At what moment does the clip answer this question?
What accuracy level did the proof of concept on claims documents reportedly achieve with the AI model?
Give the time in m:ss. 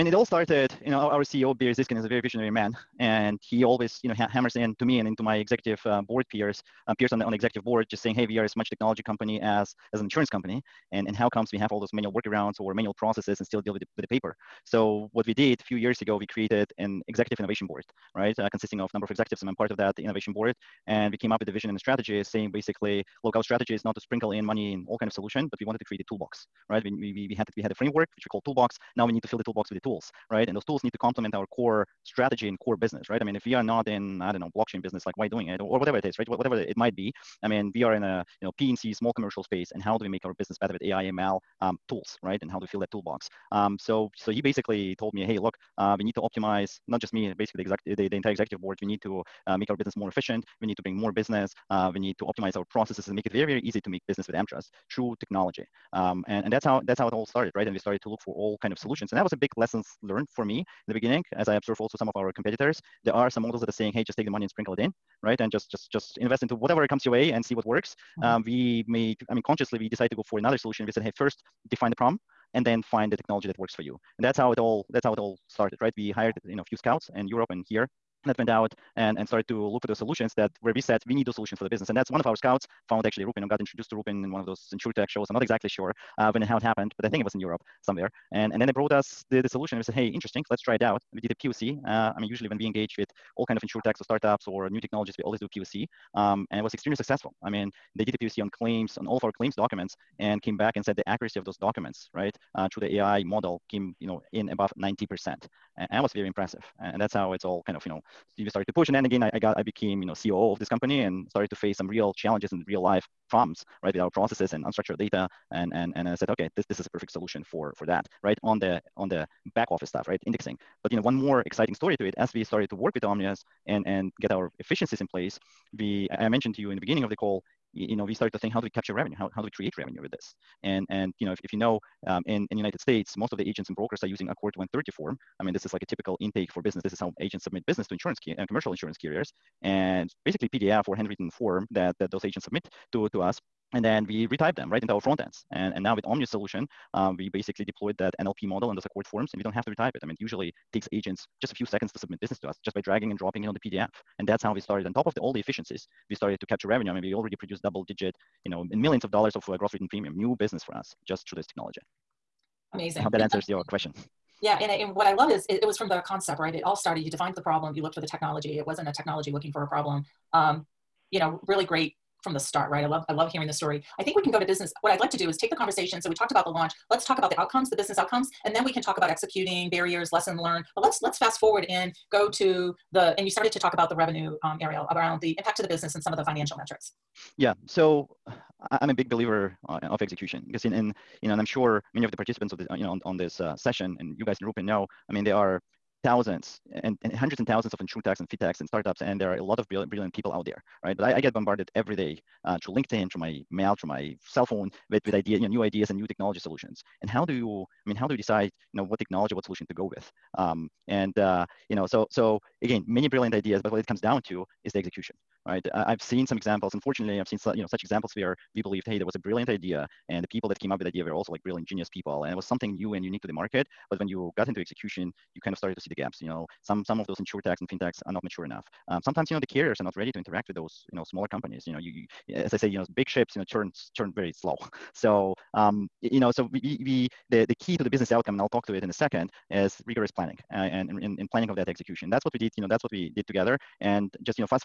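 1:44.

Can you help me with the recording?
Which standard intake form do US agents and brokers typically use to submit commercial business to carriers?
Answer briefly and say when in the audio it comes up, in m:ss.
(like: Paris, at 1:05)
ACORD 130, at 2:14.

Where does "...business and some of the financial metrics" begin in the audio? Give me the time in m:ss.
3:05.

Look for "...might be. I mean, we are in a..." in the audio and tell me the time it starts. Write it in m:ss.
0:36.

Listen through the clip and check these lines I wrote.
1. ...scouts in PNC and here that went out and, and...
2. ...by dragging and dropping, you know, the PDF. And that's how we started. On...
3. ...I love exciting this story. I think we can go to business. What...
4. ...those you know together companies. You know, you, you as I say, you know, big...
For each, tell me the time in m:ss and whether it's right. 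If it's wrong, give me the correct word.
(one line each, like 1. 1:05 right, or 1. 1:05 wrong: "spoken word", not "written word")
1. 1:16 wrong: "Europe", not "PNC"
2. 2:32 right
3. 2:53 wrong: "hearing", not "exciting"
4. 3:50 wrong: "smaller", not "together".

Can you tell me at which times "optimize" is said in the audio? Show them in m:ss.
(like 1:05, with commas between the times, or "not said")
0:46, 0:52.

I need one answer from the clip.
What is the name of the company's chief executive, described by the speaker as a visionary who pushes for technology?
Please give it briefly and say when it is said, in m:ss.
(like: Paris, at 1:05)
Barry Zyskind, at 0:01.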